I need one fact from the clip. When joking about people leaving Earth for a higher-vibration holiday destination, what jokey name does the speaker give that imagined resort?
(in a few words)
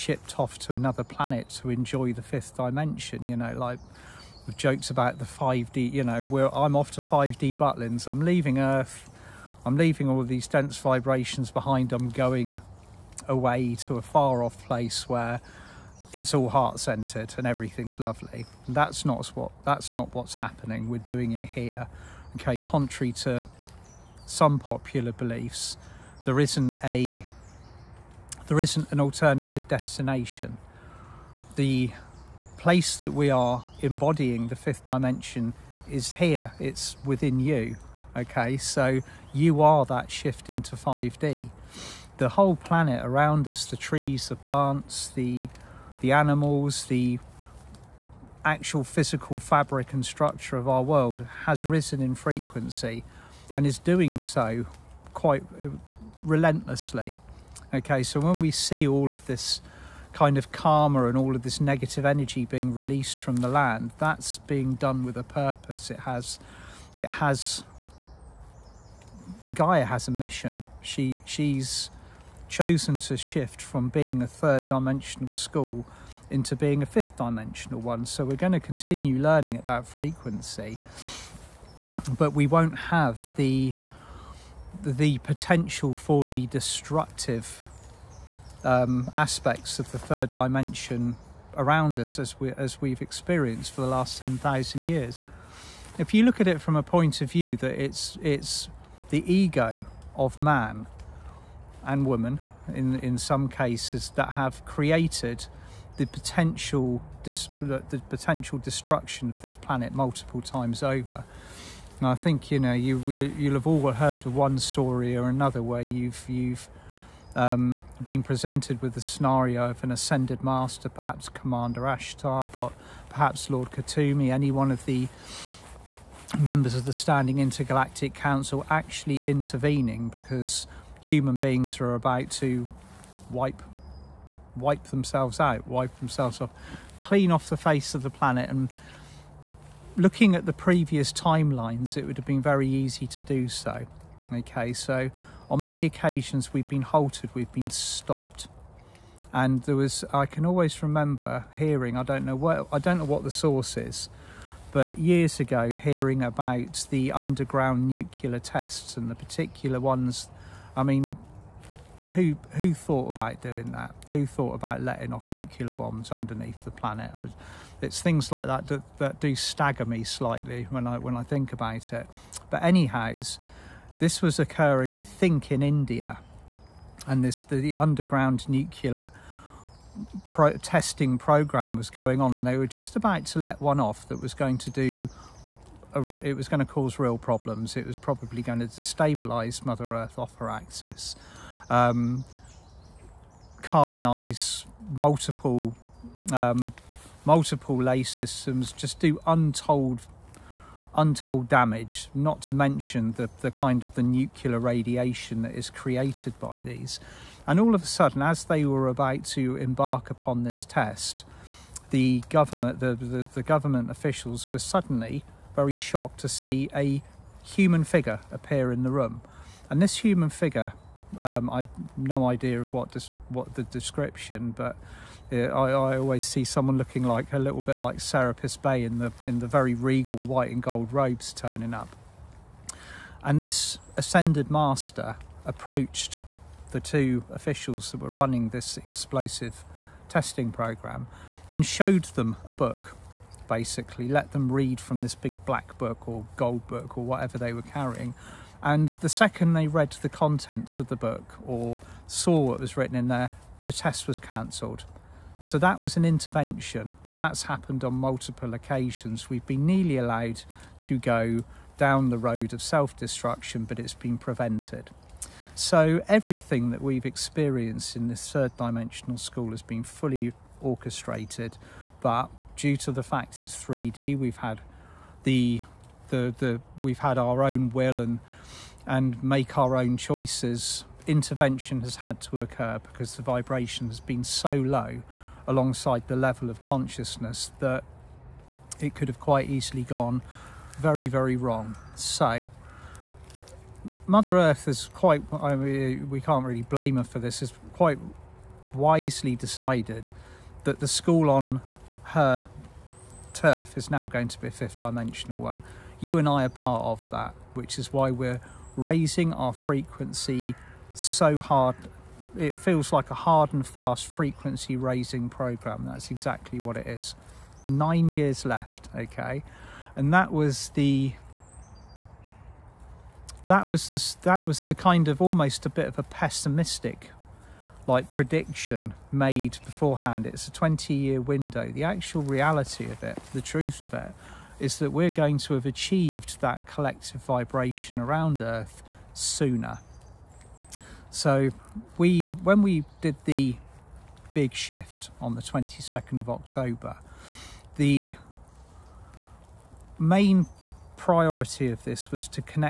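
5D Butlins.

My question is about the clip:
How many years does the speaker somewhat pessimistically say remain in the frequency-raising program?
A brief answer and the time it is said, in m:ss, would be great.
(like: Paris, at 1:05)
9, at 5:17.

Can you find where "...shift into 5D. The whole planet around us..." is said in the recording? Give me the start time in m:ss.
0:40.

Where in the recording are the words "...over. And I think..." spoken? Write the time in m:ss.
1:50.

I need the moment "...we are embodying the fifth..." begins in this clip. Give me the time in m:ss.
0:33.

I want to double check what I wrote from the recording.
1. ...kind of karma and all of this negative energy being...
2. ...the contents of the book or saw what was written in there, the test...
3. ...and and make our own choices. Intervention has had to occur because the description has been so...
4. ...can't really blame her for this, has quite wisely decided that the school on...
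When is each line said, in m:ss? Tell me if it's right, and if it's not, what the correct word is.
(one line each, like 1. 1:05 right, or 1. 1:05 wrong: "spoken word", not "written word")
1. 1:00 right
2. 4:10 right
3. 4:37 wrong: "vibration", not "description"
4. 4:56 right.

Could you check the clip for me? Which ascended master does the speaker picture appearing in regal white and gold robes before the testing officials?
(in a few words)
Serapis Bey.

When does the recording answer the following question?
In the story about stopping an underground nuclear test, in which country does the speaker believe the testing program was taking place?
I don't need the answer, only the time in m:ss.
2:55.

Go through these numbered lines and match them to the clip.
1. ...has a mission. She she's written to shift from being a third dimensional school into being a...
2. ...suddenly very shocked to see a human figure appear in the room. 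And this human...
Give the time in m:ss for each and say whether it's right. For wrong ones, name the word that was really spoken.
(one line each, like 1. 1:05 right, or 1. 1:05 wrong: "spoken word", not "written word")
1. 1:09 wrong: "chosen", not "written"
2. 3:34 right.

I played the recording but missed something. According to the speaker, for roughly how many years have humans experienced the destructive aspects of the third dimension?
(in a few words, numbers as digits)
10,000.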